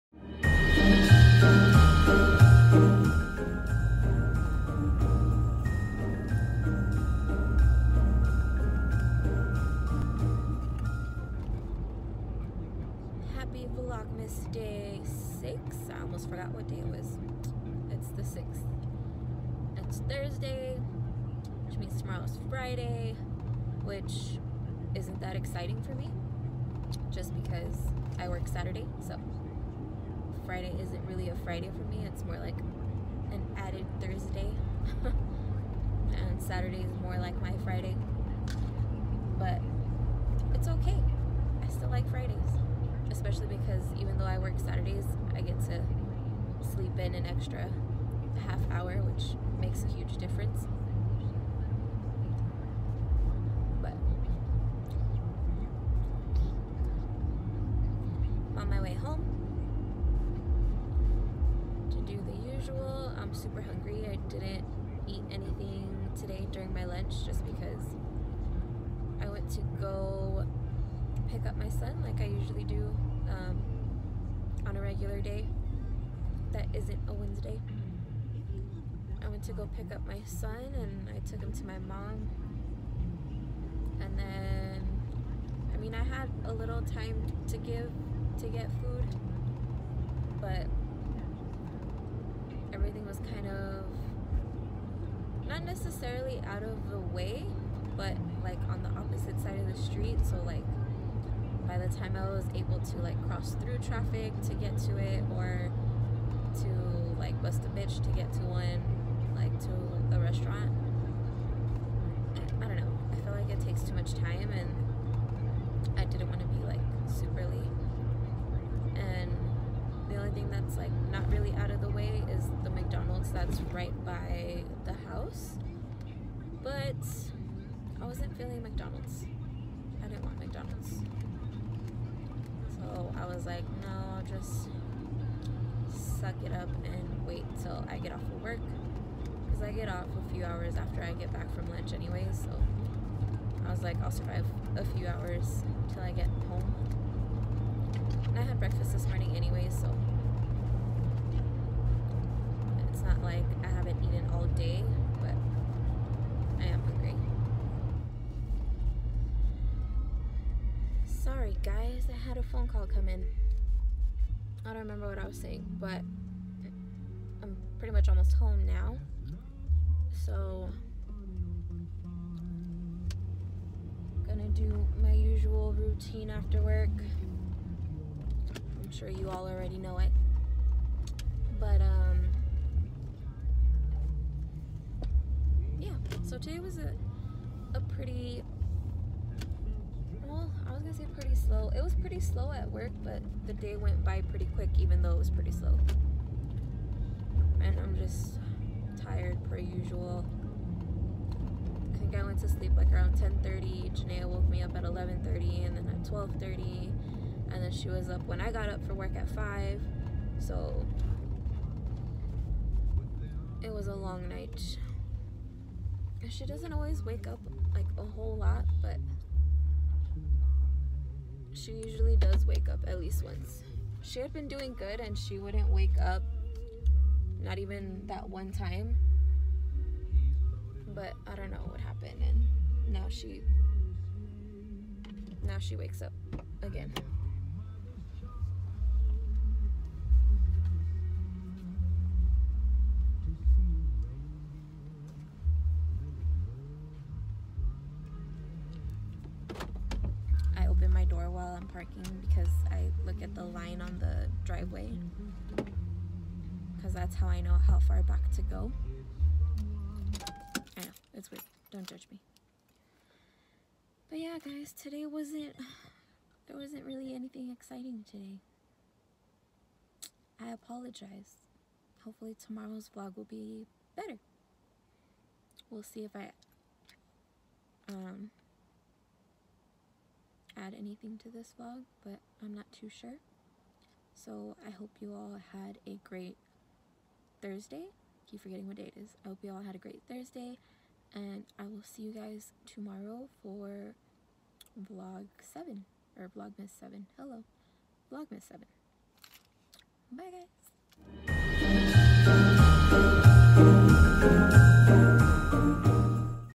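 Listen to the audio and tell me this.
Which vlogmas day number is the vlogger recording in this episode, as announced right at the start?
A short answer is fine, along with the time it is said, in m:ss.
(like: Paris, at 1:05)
6, at 0:15.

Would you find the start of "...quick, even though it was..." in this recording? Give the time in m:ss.
3:14.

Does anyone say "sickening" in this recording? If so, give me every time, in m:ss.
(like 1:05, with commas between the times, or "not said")
not said.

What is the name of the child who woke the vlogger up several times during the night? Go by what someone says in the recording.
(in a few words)
Janae.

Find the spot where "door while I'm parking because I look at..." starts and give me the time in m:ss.
4:11.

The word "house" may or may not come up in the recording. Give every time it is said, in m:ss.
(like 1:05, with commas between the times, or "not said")
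2:05.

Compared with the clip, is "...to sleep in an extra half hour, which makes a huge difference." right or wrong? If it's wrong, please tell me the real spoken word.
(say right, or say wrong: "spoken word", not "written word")
right.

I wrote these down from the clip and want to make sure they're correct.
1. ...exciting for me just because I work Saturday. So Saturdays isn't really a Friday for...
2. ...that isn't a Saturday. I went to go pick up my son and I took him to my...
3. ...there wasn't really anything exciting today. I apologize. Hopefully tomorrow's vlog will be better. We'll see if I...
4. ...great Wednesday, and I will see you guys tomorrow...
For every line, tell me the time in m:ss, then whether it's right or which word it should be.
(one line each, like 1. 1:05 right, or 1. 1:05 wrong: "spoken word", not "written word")
1. 0:25 wrong: "Friday", not "Saturdays"
2. 1:16 wrong: "Wednesday", not "Saturday"
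3. 4:26 right
4. 4:49 wrong: "Thursday", not "Wednesday".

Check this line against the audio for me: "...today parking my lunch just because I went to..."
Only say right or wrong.
wrong.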